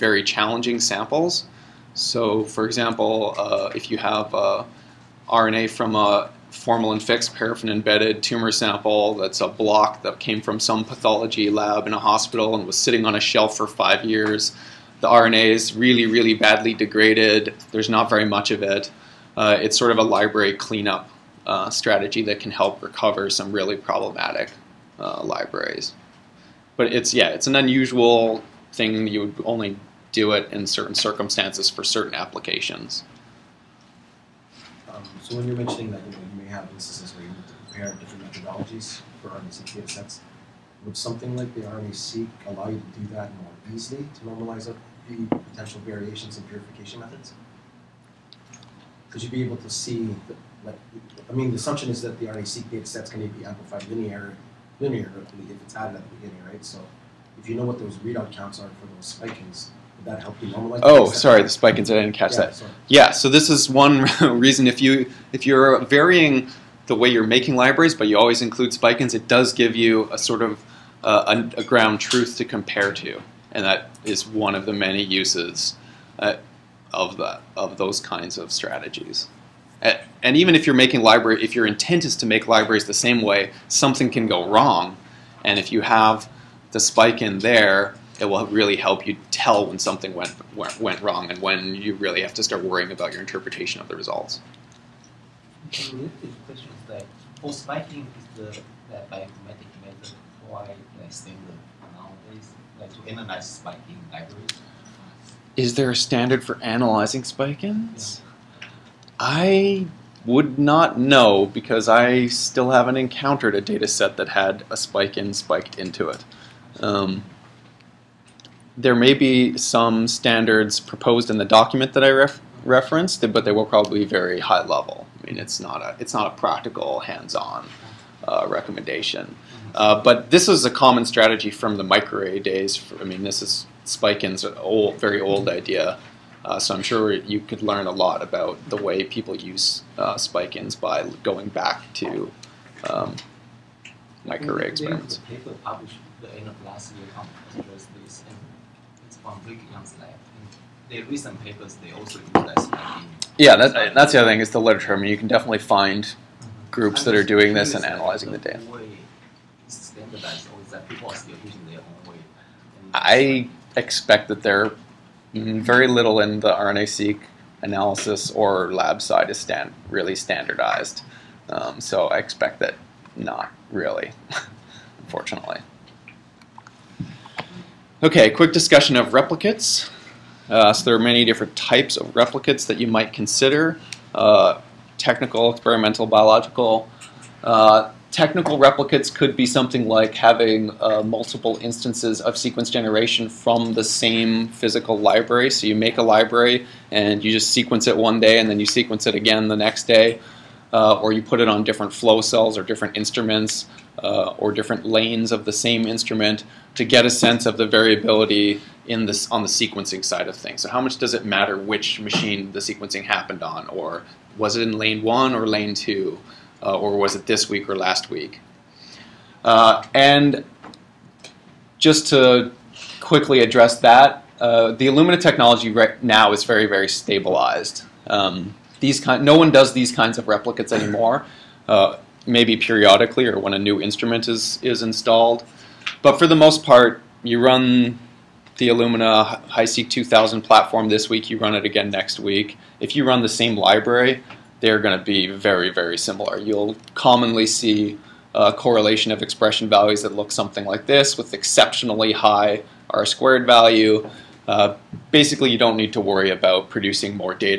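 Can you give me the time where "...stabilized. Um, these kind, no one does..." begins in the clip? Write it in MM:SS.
03:46.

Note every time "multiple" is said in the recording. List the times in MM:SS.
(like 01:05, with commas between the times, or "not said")
03:11.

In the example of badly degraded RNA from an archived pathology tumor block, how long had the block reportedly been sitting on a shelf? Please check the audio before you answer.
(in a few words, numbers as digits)
5 years.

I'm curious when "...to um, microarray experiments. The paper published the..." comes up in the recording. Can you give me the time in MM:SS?
02:21.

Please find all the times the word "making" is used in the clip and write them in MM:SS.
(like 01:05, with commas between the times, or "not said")
01:07, 01:20.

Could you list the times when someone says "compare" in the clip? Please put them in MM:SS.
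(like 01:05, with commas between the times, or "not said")
00:37, 01:12.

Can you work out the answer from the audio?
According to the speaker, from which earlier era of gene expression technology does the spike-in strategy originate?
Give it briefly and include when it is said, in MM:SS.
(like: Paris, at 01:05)
microarray days, at 02:11.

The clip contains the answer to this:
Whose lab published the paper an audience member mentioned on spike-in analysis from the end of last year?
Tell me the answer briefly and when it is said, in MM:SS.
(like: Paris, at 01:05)
Rick Young's lab, at 02:29.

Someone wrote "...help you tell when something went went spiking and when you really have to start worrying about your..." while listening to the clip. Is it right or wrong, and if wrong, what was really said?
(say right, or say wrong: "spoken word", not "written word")
wrong: "wrong", not "spiking".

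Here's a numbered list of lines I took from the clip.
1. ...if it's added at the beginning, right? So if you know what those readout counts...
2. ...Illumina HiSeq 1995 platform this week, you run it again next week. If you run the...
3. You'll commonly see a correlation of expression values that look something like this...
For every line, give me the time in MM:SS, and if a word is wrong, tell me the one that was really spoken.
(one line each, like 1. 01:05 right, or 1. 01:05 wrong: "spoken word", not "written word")
1. 00:55 right
2. 03:58 wrong: "2000", not "1995"
3. 04:06 right.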